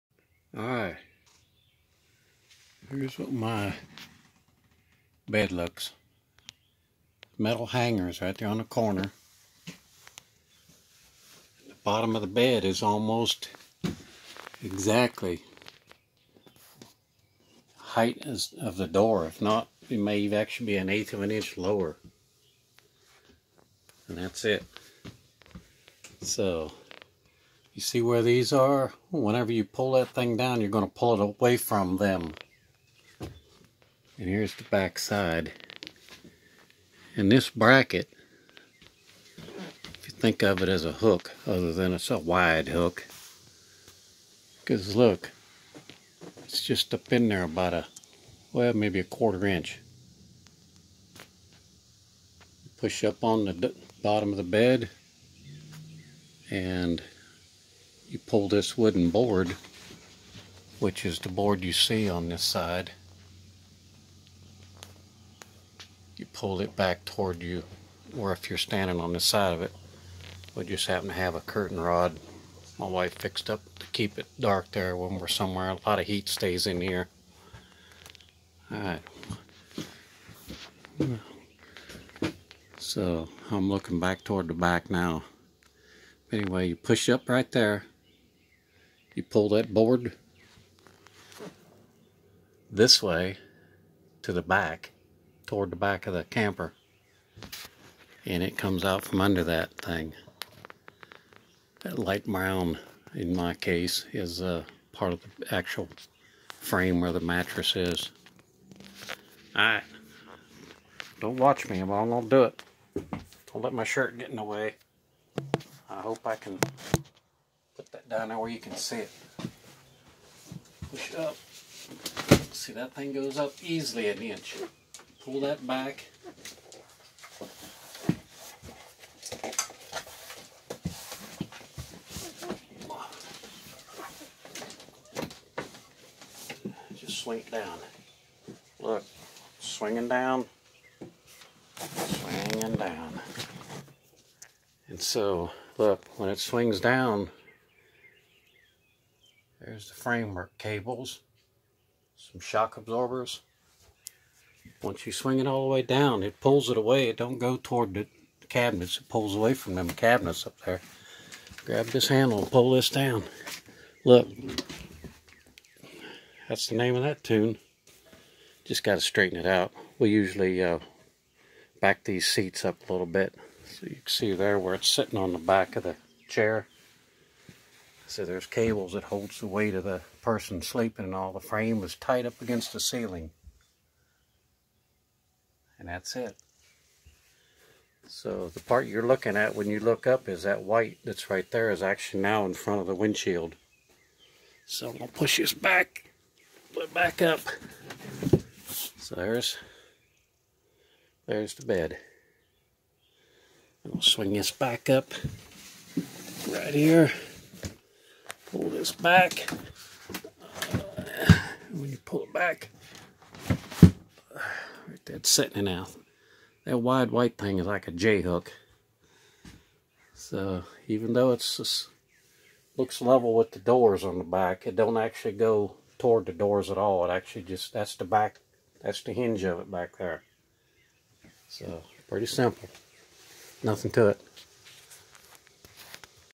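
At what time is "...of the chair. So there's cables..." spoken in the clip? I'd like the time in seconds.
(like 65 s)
175 s.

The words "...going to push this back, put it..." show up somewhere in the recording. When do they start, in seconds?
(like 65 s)
194 s.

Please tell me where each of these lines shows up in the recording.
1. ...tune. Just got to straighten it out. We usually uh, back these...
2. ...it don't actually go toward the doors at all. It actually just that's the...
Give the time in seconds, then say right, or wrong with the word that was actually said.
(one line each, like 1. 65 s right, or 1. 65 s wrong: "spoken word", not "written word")
1. 167 s right
2. 224 s right.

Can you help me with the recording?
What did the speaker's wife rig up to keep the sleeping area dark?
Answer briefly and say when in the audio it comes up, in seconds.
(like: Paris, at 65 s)
A curtain rod, at 71 s.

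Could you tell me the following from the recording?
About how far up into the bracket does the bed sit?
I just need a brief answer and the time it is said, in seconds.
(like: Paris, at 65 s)
1/4 inch, at 48 s.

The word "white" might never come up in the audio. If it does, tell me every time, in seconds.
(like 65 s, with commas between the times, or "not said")
190 s, 217 s.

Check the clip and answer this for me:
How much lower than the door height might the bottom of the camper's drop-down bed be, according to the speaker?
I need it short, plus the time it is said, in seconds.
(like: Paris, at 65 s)
1/8 inch, at 20 s.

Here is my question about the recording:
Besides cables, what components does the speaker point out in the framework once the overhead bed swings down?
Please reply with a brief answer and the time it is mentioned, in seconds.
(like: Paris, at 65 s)
Shock absorbers, at 152 s.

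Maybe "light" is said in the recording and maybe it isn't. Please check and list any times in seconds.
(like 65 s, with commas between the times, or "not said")
101 s.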